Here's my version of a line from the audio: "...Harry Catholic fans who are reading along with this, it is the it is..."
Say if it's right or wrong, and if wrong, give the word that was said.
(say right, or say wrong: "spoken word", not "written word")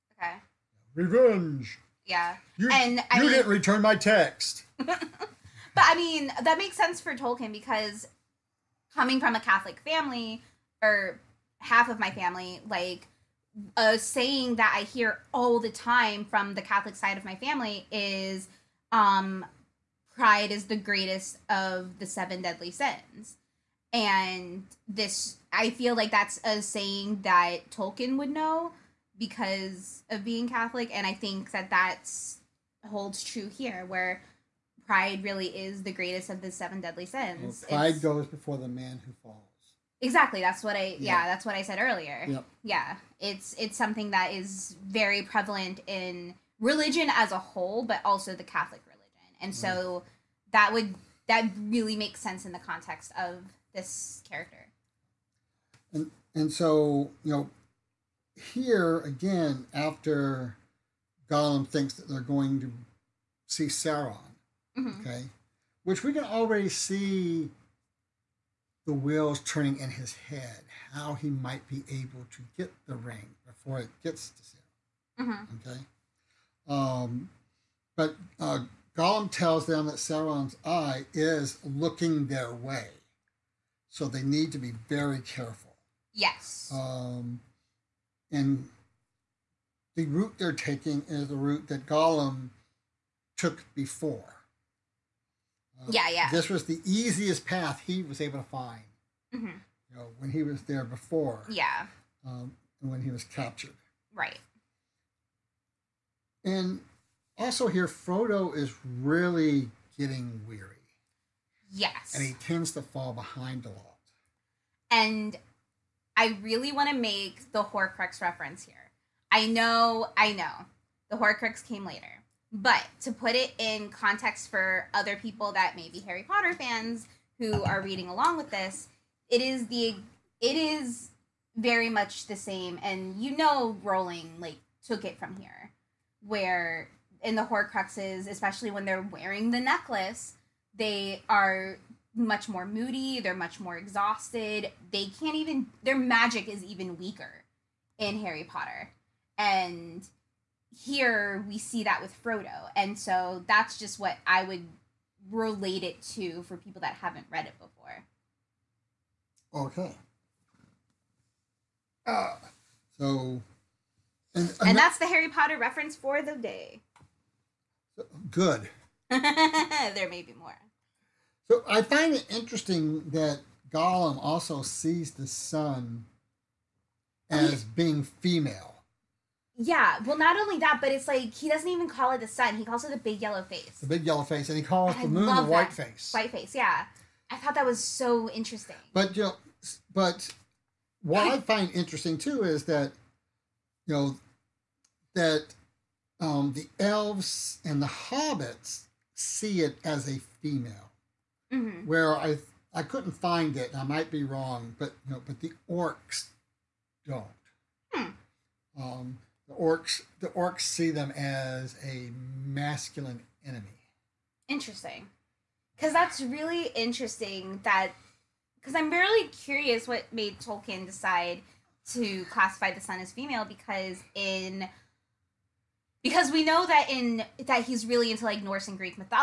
wrong: "Potter", not "Catholic".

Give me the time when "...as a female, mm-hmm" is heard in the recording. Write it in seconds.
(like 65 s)
199 s.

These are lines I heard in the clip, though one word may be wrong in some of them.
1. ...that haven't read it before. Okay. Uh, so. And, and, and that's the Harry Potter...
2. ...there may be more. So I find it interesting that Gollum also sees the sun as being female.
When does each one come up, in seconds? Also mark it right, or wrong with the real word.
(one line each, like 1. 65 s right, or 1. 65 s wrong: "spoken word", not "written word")
1. 156 s right
2. 169 s right.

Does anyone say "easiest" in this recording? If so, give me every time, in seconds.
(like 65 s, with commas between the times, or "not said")
96 s.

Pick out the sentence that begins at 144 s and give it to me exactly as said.
They can't even their magic is even weaker in Harry Potter.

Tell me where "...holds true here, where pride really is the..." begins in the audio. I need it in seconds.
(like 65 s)
32 s.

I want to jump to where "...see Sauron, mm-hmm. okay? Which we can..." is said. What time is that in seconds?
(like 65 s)
63 s.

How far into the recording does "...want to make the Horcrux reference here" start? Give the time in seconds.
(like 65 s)
116 s.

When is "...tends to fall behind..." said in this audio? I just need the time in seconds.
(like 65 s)
112 s.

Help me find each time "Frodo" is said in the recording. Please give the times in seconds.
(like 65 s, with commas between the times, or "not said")
107 s, 152 s.